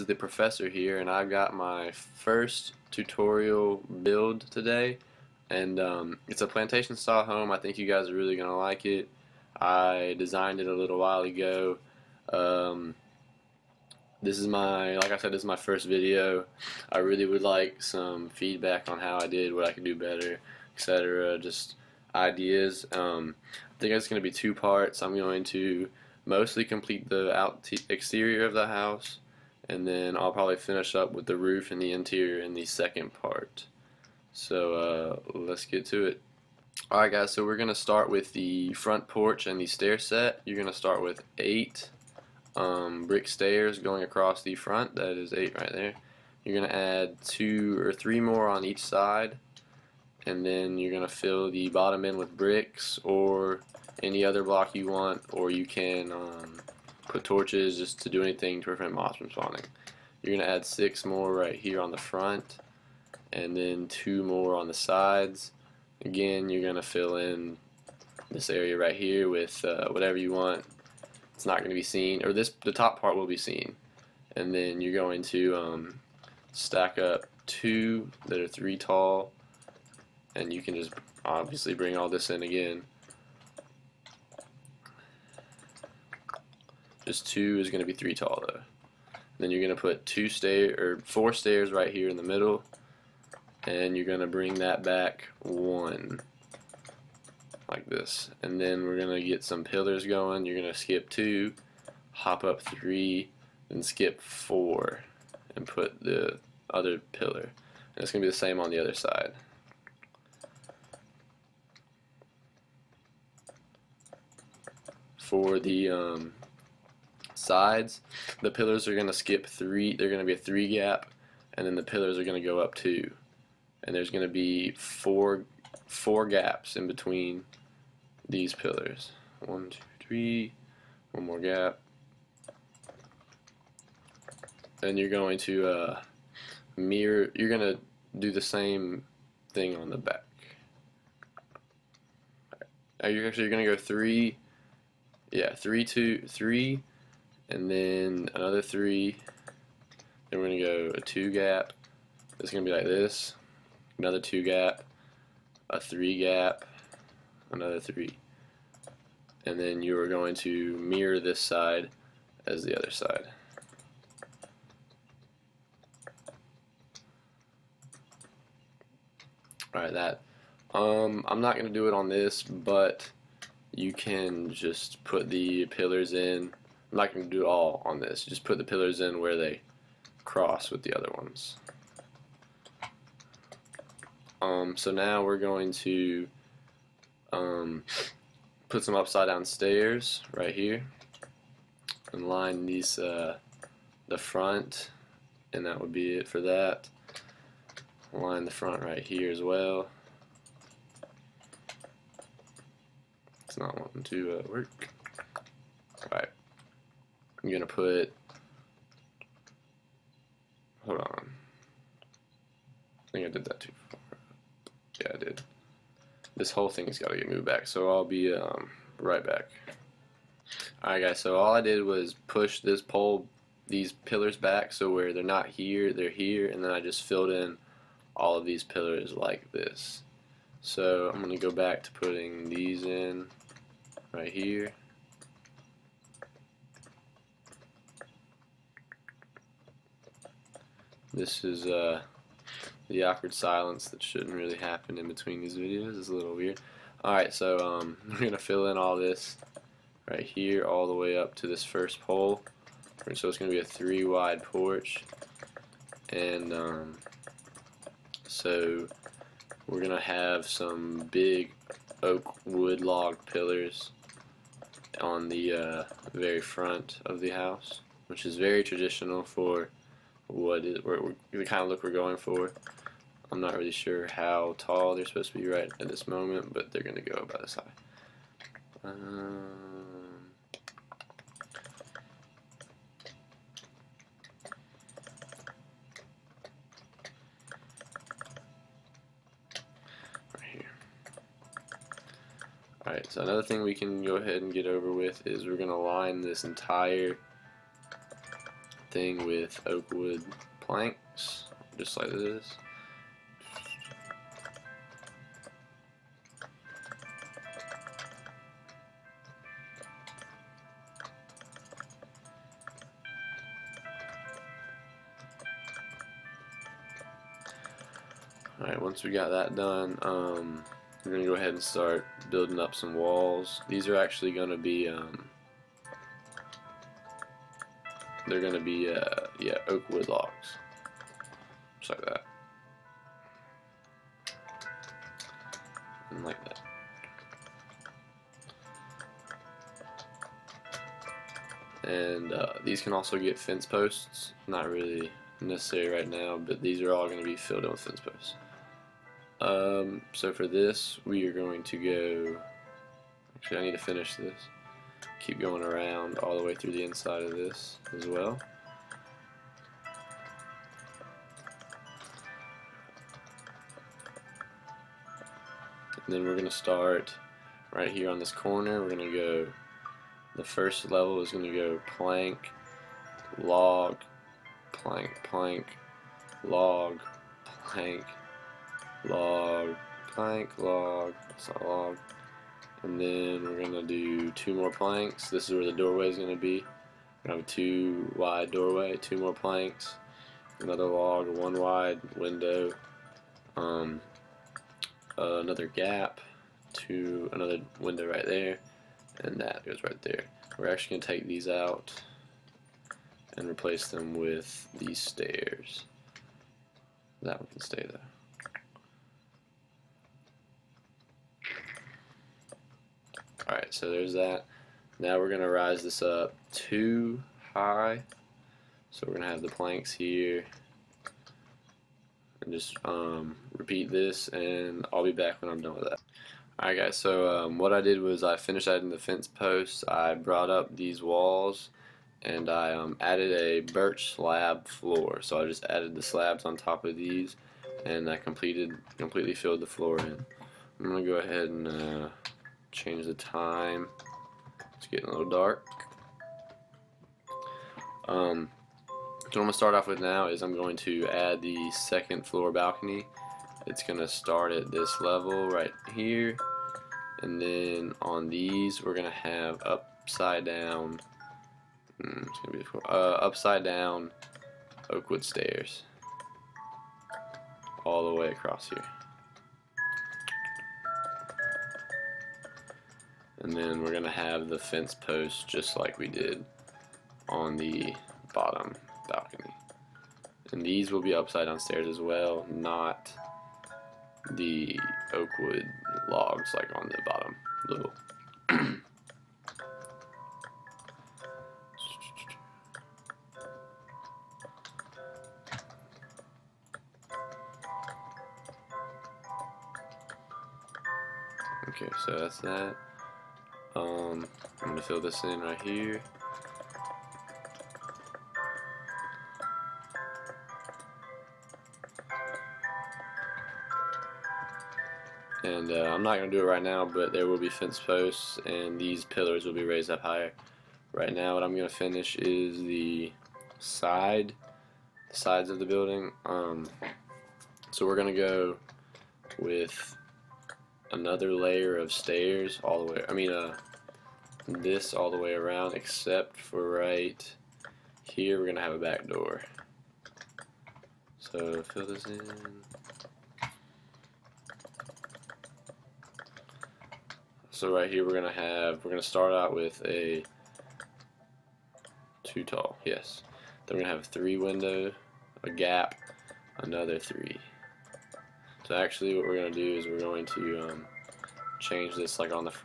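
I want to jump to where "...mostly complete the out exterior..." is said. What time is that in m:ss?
0:26.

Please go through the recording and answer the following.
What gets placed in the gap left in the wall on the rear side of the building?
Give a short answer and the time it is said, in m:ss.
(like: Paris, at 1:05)
A back door, at 8:58.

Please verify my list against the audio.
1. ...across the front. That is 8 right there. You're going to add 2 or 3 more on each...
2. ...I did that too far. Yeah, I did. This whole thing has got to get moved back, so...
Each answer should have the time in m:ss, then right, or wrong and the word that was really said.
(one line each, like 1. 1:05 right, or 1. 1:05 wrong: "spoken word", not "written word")
1. 0:44 right
2. 3:33 right.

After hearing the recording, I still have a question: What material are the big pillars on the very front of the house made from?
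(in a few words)
Oak wood log.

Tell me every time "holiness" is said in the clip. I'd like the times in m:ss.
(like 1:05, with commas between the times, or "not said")
not said.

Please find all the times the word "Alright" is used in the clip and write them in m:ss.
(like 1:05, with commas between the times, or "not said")
0:36, 2:49, 3:40, 4:07, 4:52, 5:18, 6:53, 7:06.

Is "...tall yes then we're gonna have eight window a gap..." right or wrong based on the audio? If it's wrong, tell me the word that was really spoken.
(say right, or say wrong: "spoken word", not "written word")
wrong: "three", not "eight".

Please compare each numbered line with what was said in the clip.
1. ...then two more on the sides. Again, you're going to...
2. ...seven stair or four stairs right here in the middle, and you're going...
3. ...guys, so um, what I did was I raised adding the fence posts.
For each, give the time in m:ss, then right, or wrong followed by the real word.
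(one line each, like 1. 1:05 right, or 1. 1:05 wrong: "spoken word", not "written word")
1. 1:03 right
2. 1:30 wrong: "two", not "seven"
3. 7:06 wrong: "finished", not "raised".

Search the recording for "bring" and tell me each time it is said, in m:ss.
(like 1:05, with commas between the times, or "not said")
1:21, 1:34.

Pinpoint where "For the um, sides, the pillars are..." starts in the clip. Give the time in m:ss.
1:55.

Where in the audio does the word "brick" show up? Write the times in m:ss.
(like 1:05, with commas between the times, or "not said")
0:43, 0:52.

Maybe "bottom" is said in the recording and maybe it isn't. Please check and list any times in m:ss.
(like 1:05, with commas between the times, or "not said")
0:51, 7:58, 8:07.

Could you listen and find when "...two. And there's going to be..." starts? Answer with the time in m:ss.
2:02.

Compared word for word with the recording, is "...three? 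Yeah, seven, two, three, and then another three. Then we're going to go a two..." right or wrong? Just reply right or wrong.
wrong.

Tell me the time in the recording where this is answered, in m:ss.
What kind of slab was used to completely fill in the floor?
7:13.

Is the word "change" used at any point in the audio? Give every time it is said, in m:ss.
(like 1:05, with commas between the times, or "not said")
7:22, 9:21.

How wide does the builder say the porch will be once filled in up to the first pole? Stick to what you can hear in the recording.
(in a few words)
Three wide.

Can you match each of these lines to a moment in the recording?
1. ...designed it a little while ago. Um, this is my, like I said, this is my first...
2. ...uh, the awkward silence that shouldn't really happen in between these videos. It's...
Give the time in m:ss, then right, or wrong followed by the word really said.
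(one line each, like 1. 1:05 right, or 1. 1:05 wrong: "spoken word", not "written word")
1. 0:10 right
2. 4:01 right.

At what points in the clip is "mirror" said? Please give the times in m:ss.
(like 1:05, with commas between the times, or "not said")
2:16, 2:40.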